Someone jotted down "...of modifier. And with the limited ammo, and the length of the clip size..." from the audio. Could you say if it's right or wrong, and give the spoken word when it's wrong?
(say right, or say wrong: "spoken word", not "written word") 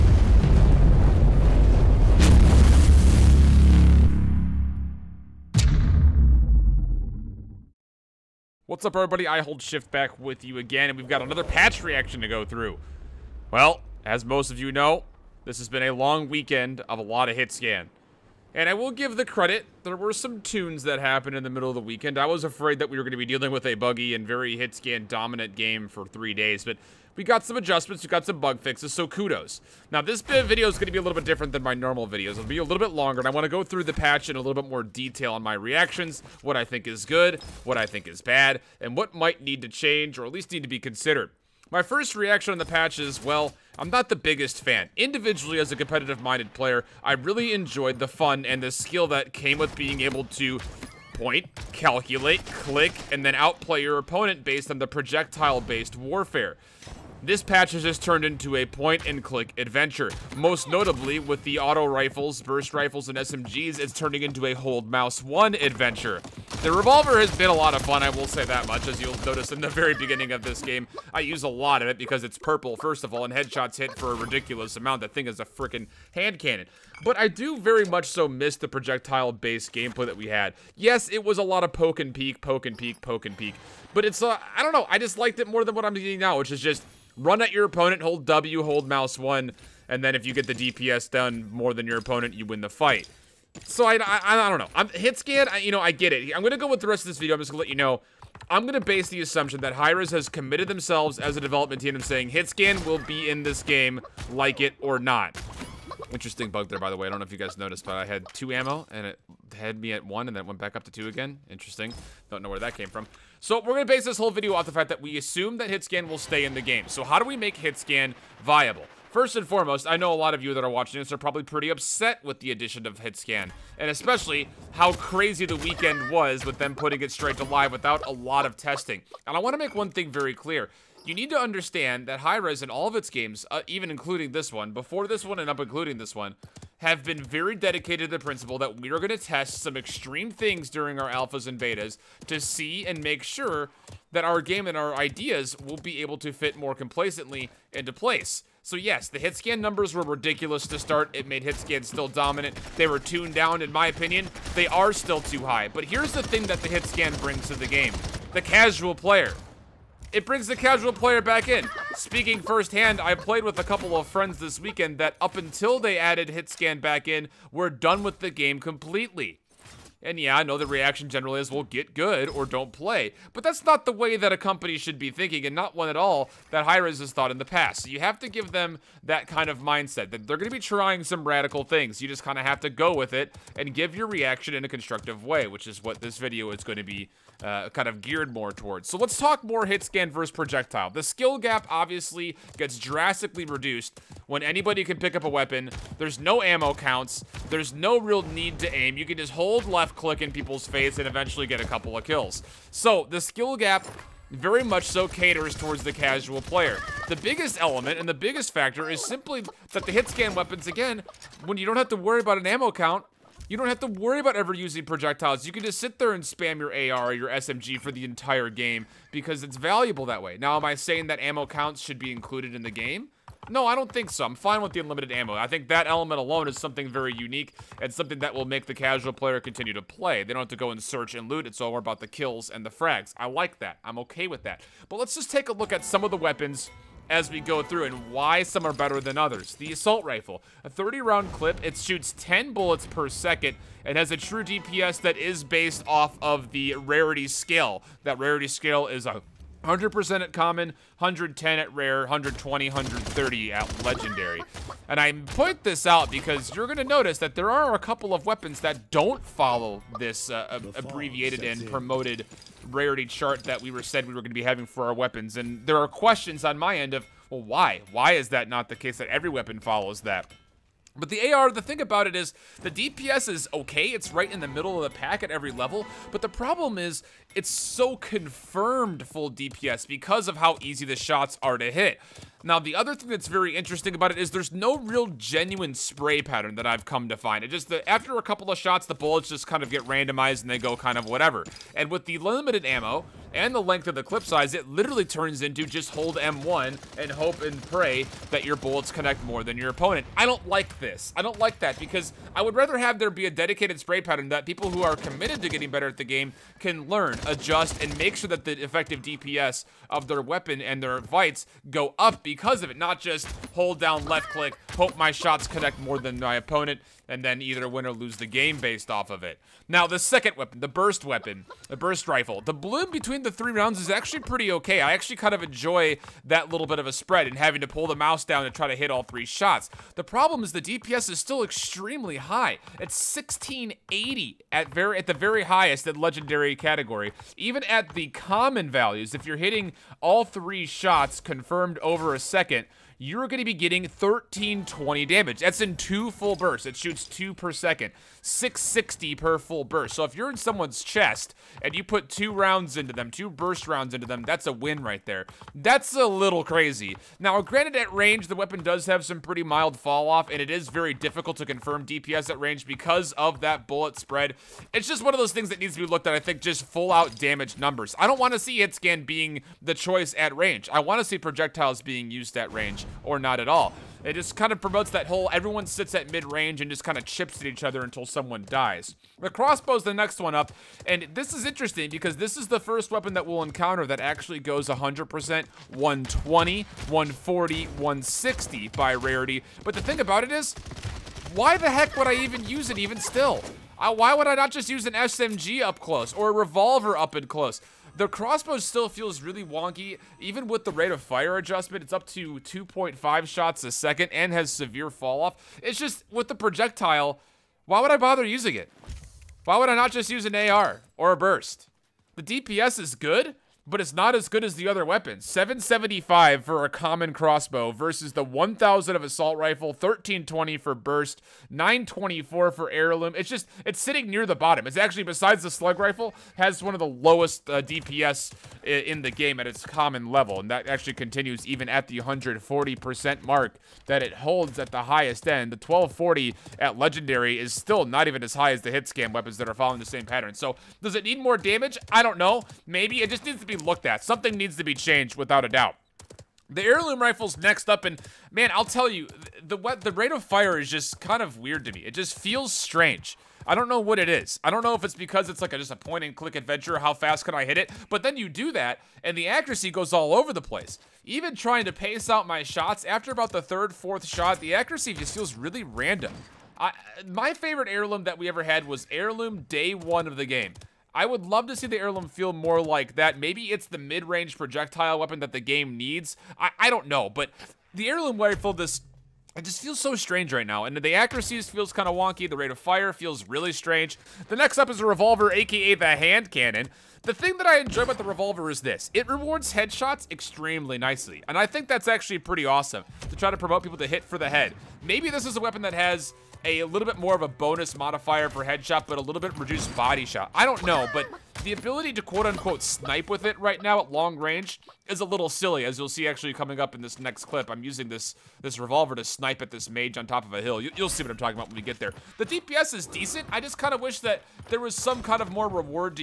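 wrong: "whatever", not "modifier".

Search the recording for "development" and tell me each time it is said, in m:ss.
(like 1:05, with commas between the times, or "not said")
1:41.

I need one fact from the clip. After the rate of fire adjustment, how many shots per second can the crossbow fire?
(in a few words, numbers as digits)
2.5.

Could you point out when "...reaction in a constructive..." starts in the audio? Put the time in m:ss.
3:04.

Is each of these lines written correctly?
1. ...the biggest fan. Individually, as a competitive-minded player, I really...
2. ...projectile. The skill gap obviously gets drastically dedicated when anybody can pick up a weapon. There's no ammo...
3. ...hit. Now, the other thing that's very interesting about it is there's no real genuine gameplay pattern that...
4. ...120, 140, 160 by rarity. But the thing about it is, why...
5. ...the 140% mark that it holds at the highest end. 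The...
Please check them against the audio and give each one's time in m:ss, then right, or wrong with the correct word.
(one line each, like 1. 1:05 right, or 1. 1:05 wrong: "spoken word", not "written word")
1. 0:44 right
2. 3:10 wrong: "reduced", not "dedicated"
3. 4:41 wrong: "spray", not "gameplay"
4. 6:25 right
5. 7:11 right.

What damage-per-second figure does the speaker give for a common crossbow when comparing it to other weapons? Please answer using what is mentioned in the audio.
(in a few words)
775.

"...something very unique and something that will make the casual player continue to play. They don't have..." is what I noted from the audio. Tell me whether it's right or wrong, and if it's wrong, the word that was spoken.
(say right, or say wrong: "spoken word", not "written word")
right.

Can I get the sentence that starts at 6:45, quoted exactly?
It's just, with the projectile, why would I bother using it?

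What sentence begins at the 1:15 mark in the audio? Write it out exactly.
That thing is a freaking hand cannon.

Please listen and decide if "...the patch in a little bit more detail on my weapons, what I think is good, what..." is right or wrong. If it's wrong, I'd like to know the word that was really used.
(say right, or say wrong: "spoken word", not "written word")
wrong: "reactions", not "weapons".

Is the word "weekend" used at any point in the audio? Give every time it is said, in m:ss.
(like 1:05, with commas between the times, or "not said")
0:16, 0:21, 2:05, 2:44.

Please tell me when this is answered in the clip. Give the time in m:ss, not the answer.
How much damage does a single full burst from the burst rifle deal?
5:48.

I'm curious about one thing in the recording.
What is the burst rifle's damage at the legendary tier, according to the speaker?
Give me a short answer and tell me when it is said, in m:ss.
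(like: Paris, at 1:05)
1680, at 5:33.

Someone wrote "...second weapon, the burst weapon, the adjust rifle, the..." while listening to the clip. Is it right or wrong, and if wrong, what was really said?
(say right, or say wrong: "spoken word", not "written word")
wrong: "burst", not "adjust".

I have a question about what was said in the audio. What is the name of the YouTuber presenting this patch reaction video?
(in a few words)
iHoldShift.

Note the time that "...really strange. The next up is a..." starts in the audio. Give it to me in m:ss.
8:03.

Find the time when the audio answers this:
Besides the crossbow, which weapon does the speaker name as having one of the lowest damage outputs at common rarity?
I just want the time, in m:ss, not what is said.
7:05.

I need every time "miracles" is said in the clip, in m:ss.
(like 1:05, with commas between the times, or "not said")
not said.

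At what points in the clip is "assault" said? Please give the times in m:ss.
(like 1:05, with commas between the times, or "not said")
3:59, 6:59.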